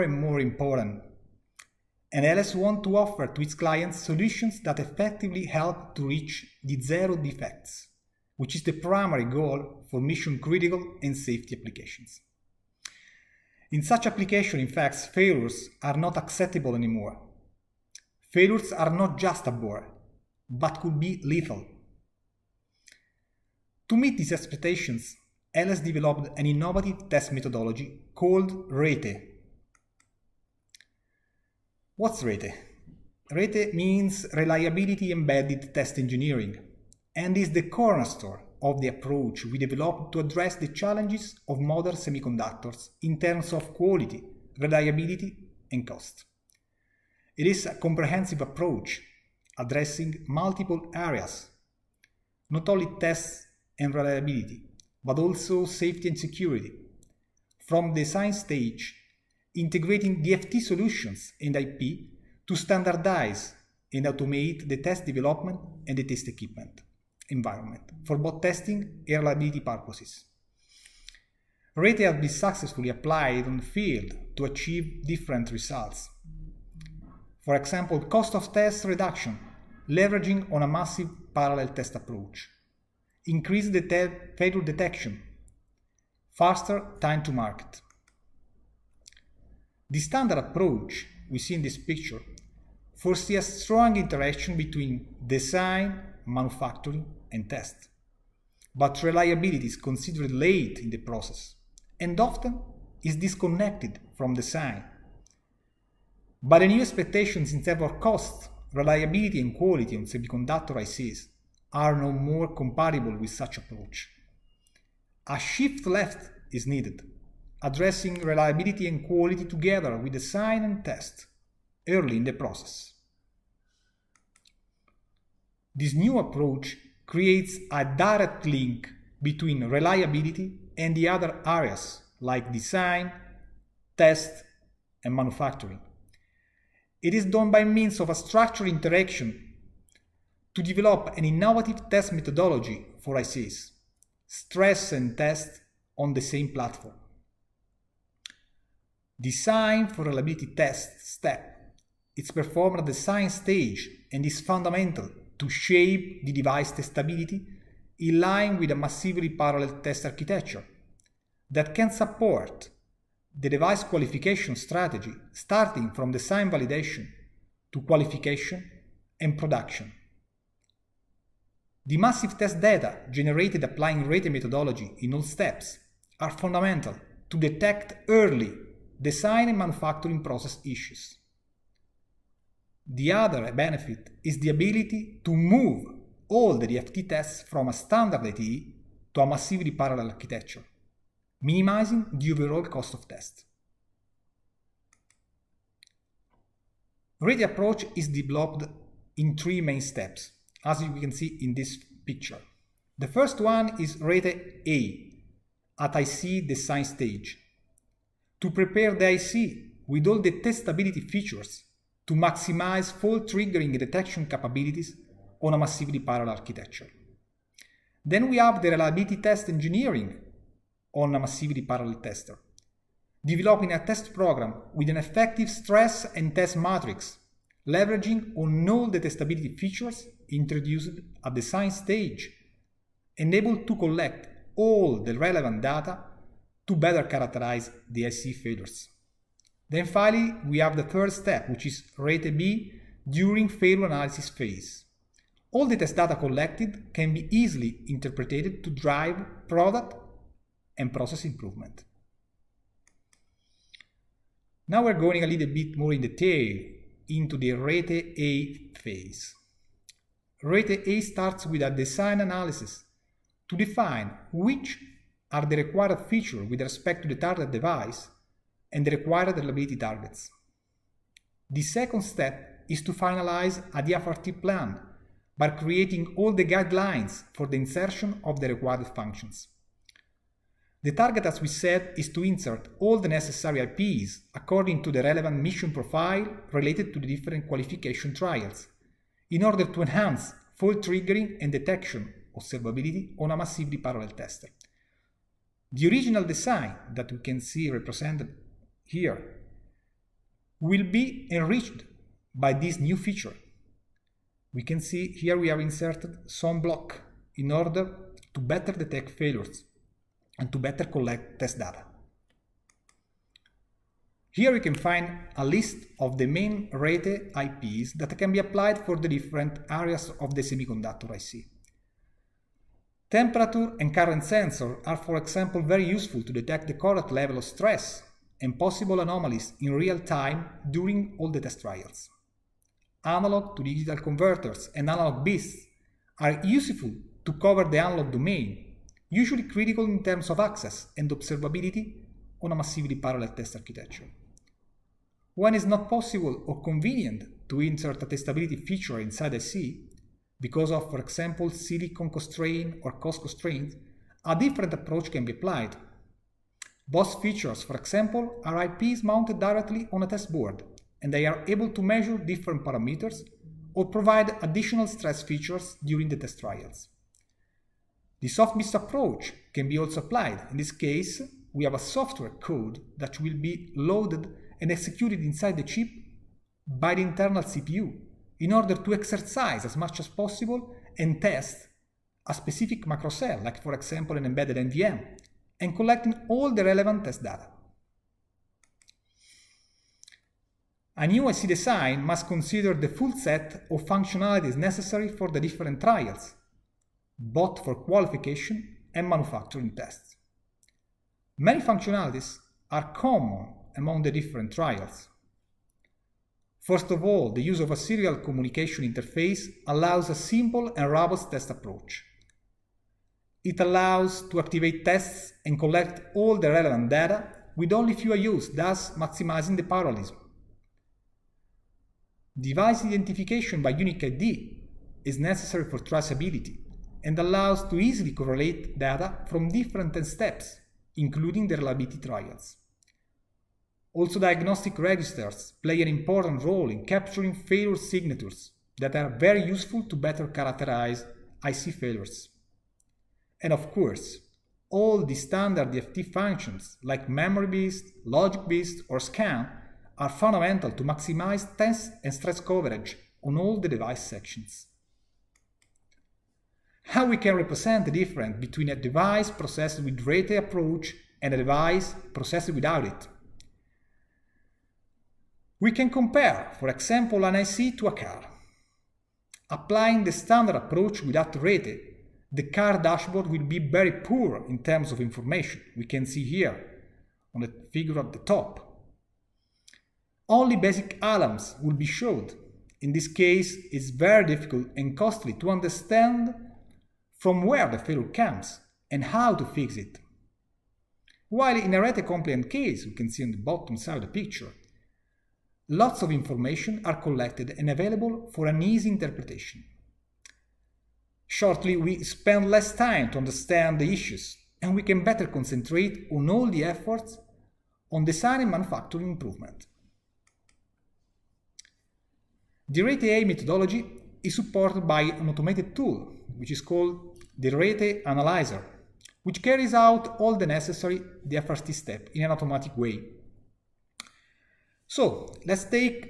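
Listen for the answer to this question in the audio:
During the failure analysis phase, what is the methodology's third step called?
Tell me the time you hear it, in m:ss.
4:01.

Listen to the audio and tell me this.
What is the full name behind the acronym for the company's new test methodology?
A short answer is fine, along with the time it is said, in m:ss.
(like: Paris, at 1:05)
Reliability Embedded Test Engineering, at 0:34.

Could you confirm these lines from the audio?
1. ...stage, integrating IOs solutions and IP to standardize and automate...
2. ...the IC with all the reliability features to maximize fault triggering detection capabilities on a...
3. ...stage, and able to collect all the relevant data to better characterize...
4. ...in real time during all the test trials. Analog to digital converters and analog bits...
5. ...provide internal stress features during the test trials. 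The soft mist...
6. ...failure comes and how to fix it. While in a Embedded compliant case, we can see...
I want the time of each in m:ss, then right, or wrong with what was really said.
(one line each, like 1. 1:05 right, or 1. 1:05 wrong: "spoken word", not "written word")
1. 0:58 wrong: "DFT", not "IOs"
2. 3:28 wrong: "testability", not "reliability"
3. 3:51 right
4. 5:29 right
5. 6:03 wrong: "additional", not "internal"
6. 8:07 wrong: "Rete", not "Embedded".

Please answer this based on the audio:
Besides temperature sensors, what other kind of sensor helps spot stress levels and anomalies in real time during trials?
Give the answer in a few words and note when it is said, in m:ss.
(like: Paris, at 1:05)
current sensor, at 5:23.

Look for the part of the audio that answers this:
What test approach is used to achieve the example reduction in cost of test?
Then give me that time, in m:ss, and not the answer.
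1:20.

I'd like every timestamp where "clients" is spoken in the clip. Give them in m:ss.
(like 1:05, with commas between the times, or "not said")
0:03.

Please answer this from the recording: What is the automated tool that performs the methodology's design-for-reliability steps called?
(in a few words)
Rete analyzer.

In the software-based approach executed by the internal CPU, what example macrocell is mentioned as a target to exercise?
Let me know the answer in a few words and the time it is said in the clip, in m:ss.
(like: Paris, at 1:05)
embedded NVM, at 6:24.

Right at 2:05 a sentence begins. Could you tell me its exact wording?
This new approach creates a direct link between reliability and the other areas like design, test, and manufacturing.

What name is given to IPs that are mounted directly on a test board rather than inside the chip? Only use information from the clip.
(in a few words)
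BOST.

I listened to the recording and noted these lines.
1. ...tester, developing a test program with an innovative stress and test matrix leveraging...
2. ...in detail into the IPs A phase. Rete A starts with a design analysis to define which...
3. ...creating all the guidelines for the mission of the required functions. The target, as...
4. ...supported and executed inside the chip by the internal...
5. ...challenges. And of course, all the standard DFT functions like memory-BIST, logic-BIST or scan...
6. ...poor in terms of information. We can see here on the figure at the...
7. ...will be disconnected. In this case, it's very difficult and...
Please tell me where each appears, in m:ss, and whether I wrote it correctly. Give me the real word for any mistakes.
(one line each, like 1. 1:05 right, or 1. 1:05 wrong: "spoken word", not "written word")
1. 3:42 wrong: "effective", not "innovative"
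2. 4:15 wrong: "Rete", not "IPs"
3. 4:35 wrong: "insertion", not "mission"
4. 6:13 wrong: "loaded", not "supported"
5. 7:21 wrong: "failures", not "challenges"
6. 7:53 right
7. 8:01 wrong: "showed", not "disconnected".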